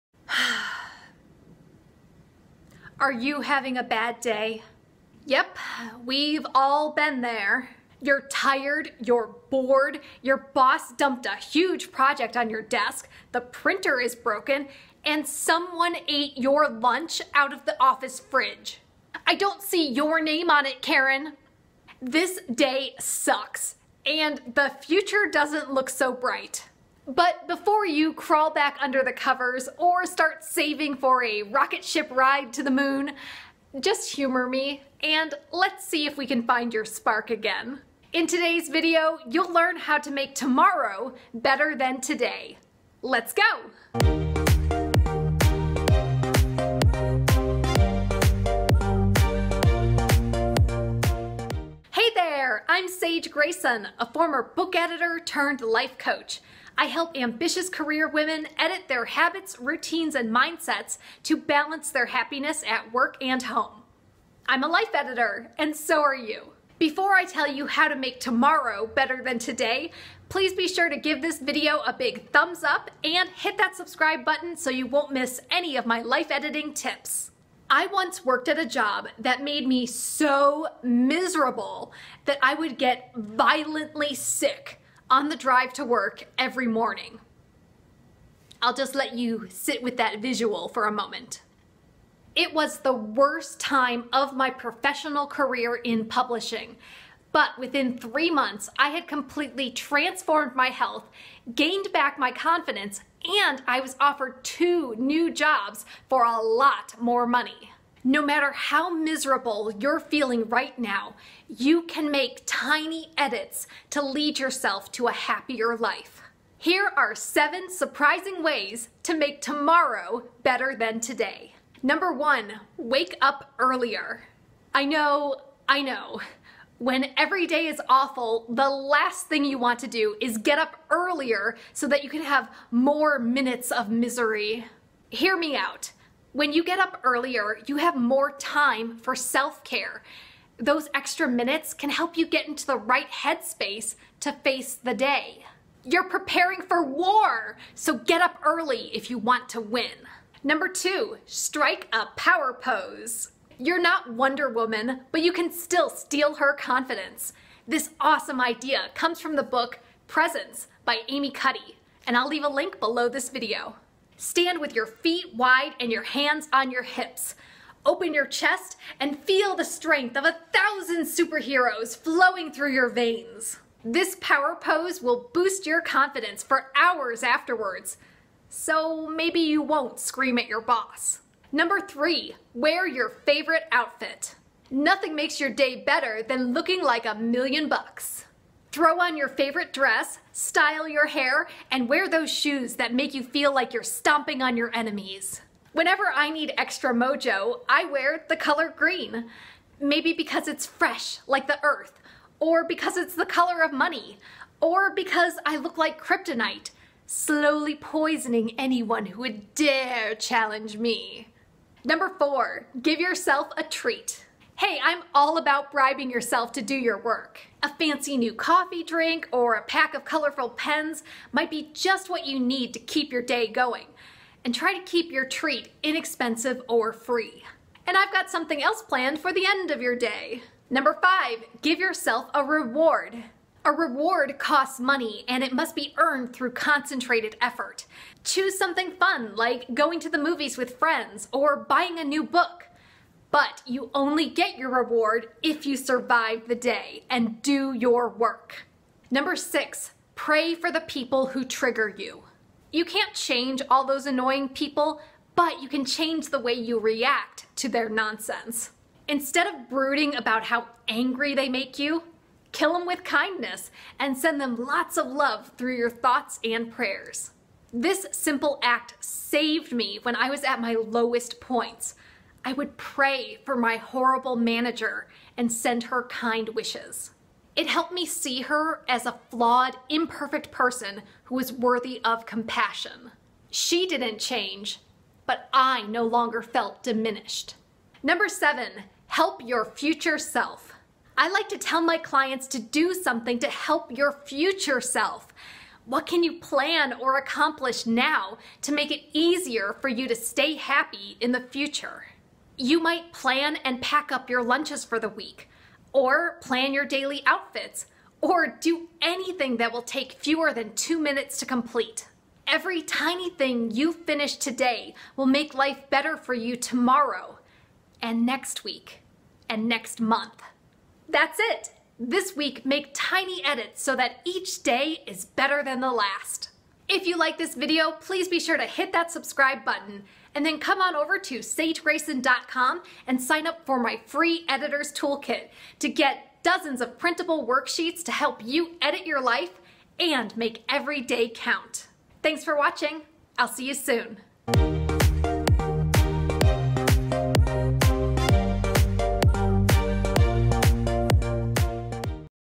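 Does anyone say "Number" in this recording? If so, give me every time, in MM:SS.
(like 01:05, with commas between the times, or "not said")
02:01, 02:30, 03:01, 03:31, 03:50, 04:09, 04:48.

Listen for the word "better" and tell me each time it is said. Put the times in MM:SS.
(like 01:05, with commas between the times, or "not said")
00:41, 01:08, 02:00, 03:05, 05:15, 05:25.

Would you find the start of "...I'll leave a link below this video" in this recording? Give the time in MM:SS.
02:42.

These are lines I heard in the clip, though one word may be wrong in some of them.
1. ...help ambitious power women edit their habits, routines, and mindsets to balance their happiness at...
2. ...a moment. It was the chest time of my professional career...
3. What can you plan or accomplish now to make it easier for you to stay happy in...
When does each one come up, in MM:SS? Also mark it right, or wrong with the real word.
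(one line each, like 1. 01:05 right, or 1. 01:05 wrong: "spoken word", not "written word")
1. 00:56 wrong: "career", not "power"
2. 01:30 wrong: "worst", not "chest"
3. 04:55 right.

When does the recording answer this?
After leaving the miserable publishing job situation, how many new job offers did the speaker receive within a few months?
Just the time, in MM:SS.
01:44.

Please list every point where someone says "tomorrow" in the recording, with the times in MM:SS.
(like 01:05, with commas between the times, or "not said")
00:40, 01:08, 01:59, 05:16.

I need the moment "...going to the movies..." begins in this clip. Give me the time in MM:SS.
03:59.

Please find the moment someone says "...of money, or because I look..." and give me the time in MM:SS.
03:23.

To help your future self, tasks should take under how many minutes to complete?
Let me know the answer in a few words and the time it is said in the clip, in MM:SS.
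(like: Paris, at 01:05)
2, at 05:10.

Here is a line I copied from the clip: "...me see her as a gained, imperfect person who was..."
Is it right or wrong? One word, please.
wrong.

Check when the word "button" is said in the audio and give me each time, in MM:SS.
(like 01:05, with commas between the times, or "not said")
01:14, 05:29.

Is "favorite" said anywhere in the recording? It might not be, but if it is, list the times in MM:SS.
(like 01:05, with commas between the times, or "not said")
03:03, 03:09.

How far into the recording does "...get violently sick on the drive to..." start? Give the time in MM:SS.
01:22.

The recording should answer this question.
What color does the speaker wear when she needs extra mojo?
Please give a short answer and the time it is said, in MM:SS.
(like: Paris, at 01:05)
Green, at 03:18.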